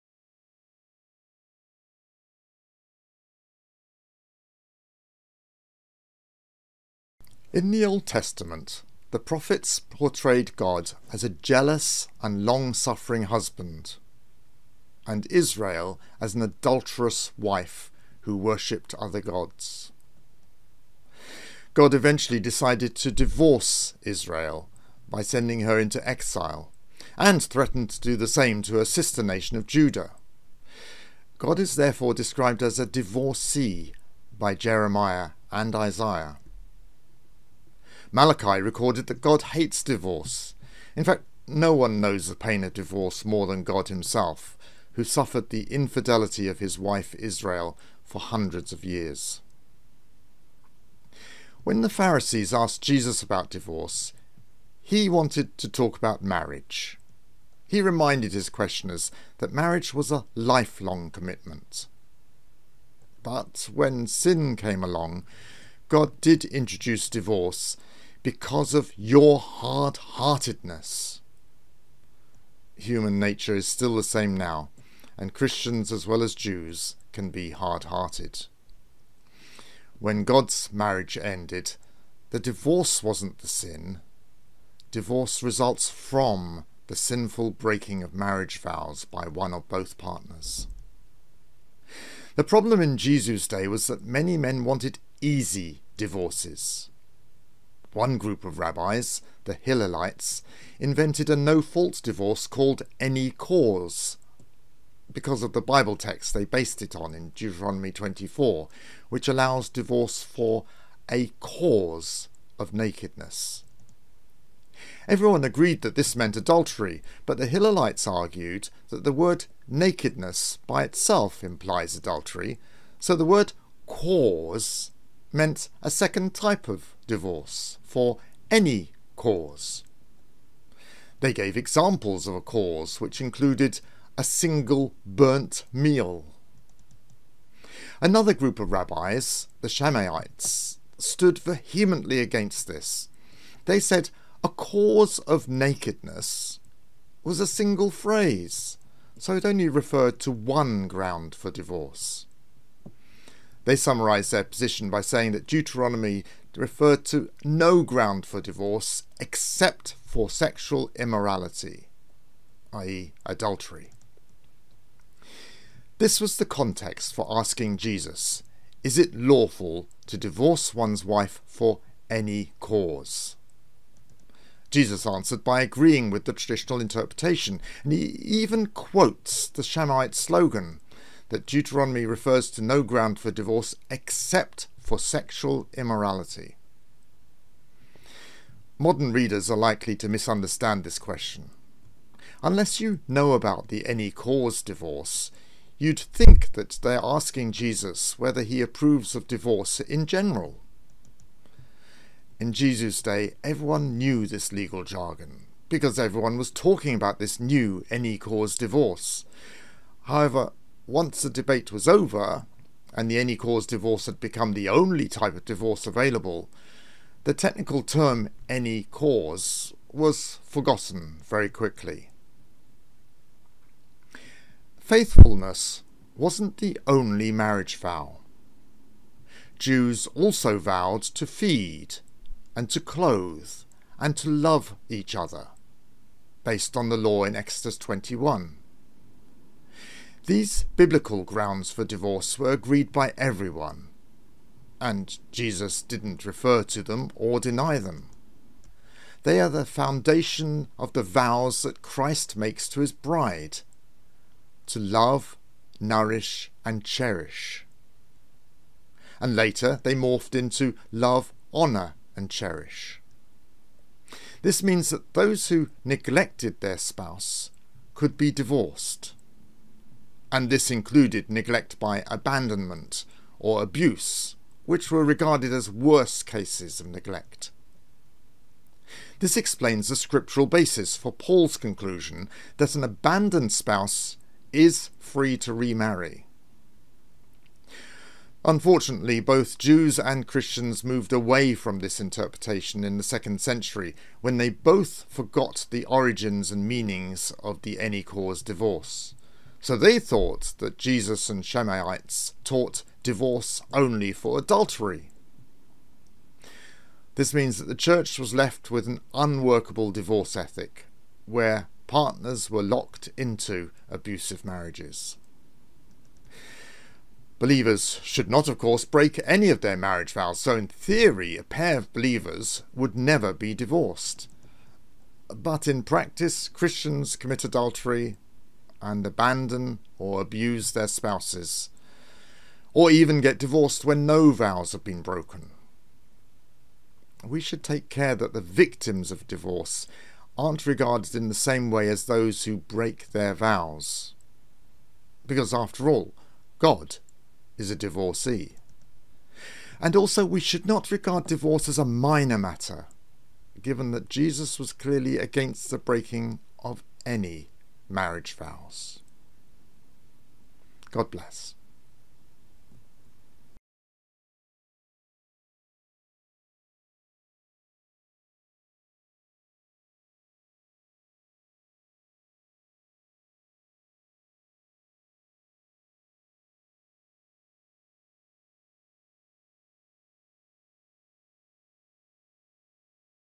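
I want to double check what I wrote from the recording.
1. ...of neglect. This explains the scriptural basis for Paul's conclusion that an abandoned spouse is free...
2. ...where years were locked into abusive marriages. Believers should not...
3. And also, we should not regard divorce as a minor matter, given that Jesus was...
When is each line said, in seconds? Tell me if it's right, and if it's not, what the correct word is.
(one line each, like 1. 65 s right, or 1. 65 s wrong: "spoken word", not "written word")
1. 276 s right
2. 311 s wrong: "partners", not "years"
3. 349 s right.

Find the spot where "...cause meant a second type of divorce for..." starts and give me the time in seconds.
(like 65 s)
123 s.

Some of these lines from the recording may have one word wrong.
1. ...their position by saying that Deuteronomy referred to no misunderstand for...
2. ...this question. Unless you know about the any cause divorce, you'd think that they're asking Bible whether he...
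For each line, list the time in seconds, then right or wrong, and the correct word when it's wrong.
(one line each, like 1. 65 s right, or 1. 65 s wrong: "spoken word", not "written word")
1. 154 s wrong: "ground", not "misunderstand"
2. 190 s wrong: "Jesus", not "Bible".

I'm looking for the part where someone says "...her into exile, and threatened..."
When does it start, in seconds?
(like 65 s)
25 s.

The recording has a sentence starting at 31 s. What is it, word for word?
God is therefore described as a divorcee by Jeremiah and Isaiah.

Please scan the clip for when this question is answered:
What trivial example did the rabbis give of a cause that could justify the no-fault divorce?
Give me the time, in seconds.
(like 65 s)
134 s.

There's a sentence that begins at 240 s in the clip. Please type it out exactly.
These biblical grounds for divorce were agreed by everyone, and Jesus didn't refer to them or deny them.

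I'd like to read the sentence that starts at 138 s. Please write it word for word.
Another group of rabbis, the Shammaites, stood vehemently against this.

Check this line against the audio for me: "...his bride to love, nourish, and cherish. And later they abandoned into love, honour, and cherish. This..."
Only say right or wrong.
wrong.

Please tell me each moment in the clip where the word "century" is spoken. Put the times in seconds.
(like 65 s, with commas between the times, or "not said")
293 s.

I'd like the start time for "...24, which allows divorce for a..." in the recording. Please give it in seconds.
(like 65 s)
107 s.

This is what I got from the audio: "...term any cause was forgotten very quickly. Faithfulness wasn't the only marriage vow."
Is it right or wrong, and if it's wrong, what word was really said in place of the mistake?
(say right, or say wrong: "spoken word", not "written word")
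right.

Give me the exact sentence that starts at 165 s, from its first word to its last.
This was the context for asking Jesus, Is it lawful to divorce one's wife for any cause?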